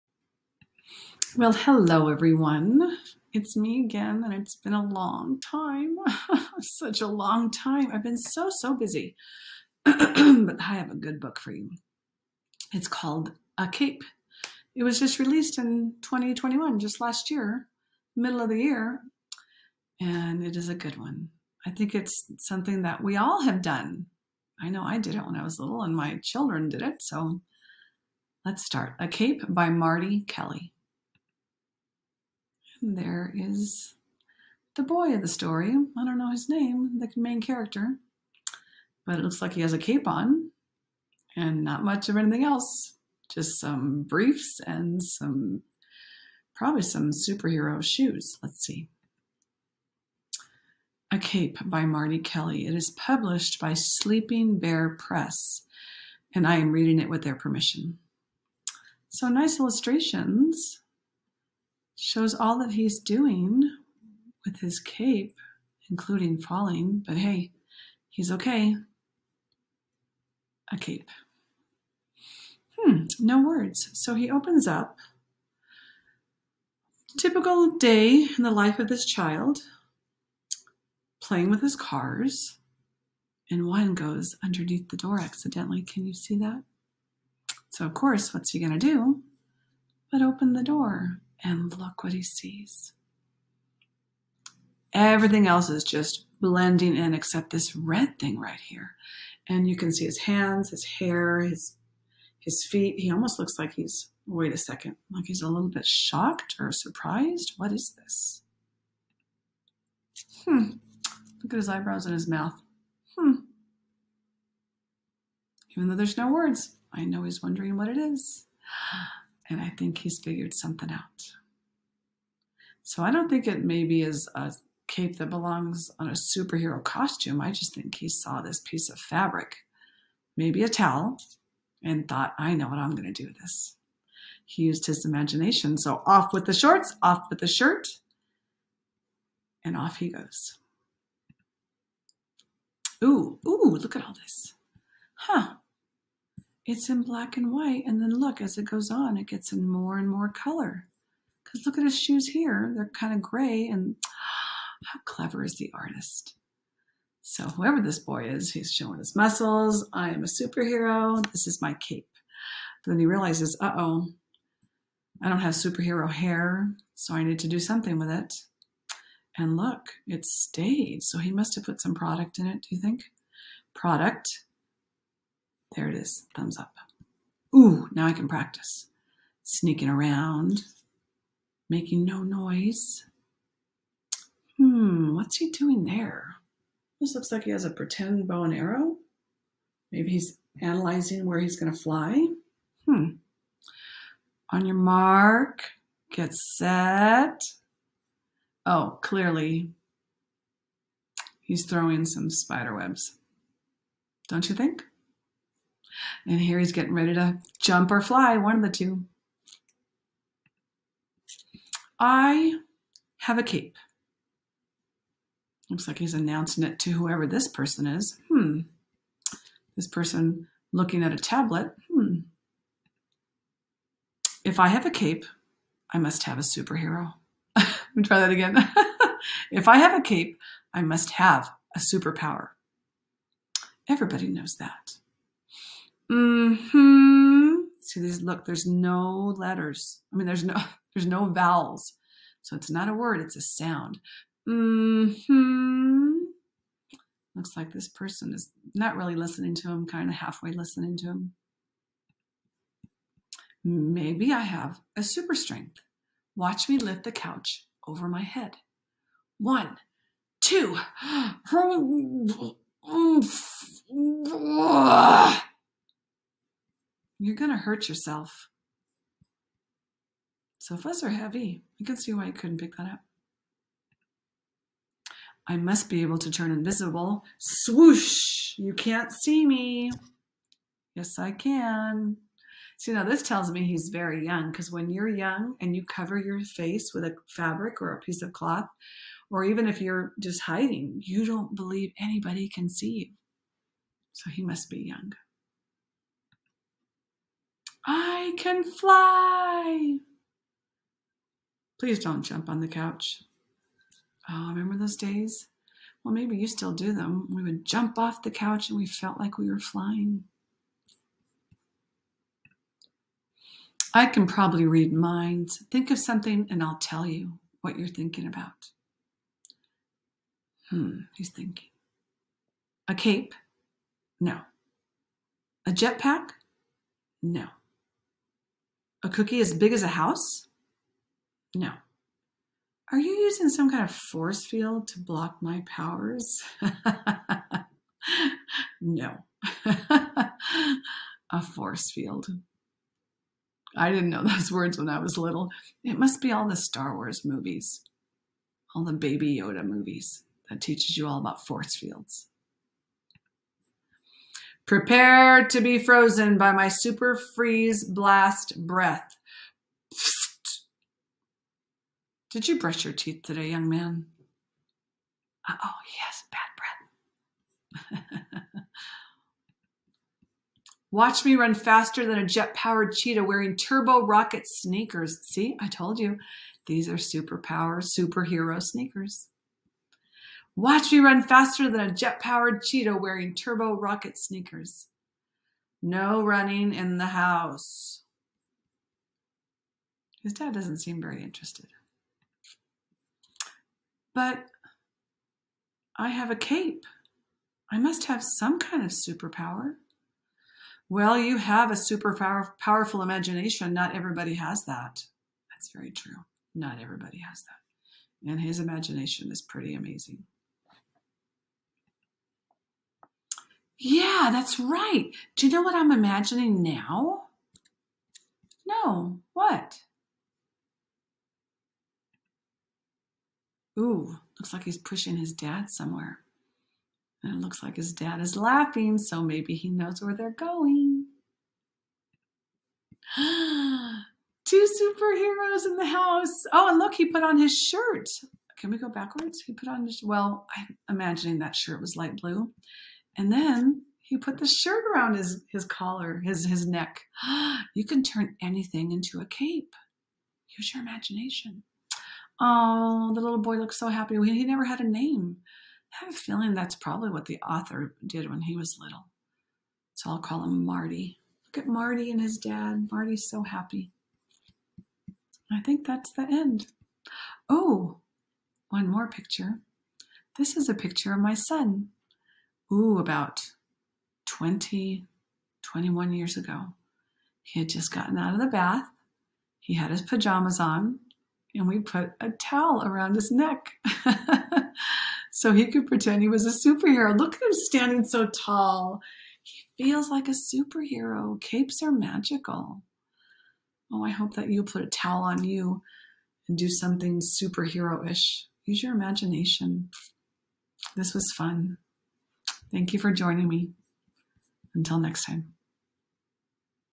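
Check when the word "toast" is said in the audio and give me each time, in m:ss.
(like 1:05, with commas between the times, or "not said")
not said.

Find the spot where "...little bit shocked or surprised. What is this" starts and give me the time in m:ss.
1:45.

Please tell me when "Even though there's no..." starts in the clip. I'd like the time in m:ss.
1:55.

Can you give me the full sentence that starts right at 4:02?
So it's not a word, it's a sound.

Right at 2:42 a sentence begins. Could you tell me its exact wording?
But then he realizes, uh-oh, I don't have superhero hair, so I need to do something with it.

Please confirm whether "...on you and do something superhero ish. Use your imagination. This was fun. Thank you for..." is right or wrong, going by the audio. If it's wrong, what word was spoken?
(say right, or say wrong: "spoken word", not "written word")
right.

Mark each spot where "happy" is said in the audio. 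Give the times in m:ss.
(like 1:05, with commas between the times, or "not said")
7:33, 7:43.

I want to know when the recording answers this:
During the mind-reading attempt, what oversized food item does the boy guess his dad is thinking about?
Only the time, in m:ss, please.
5:29.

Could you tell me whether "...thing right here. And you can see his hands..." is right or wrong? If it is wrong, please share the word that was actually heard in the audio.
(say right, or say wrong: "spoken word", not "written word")
right.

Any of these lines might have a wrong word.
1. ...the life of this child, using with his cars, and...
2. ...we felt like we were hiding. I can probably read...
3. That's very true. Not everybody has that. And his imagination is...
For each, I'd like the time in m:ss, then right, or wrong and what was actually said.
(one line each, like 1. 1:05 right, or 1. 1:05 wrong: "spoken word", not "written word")
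1. 1:18 wrong: "playing", not "using"
2. 5:08 wrong: "flying", not "hiding"
3. 6:45 right.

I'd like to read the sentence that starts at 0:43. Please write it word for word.
Just some briefs and some, probably some superhero shoes.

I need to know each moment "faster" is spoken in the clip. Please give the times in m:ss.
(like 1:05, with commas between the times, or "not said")
6:11, 6:21.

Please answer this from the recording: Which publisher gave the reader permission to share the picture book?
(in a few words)
Sleeping Bear Press.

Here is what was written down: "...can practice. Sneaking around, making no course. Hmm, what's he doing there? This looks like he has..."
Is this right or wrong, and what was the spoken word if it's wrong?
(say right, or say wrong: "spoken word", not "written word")
wrong: "noise", not "course".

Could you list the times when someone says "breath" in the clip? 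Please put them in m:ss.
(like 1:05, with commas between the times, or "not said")
5:58, 6:08.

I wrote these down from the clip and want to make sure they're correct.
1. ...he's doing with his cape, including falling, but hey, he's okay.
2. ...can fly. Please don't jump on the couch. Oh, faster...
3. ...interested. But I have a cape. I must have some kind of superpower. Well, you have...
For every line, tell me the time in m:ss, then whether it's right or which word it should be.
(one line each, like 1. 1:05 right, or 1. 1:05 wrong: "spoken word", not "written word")
1. 1:02 right
2. 4:58 wrong: "remember", not "faster"
3. 6:31 right.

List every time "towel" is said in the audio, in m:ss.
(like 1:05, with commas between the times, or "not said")
2:10, 8:02, 8:14.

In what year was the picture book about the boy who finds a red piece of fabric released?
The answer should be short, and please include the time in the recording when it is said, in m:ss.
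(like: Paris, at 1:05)
2021, at 0:16.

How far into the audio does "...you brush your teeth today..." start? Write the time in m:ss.
6:02.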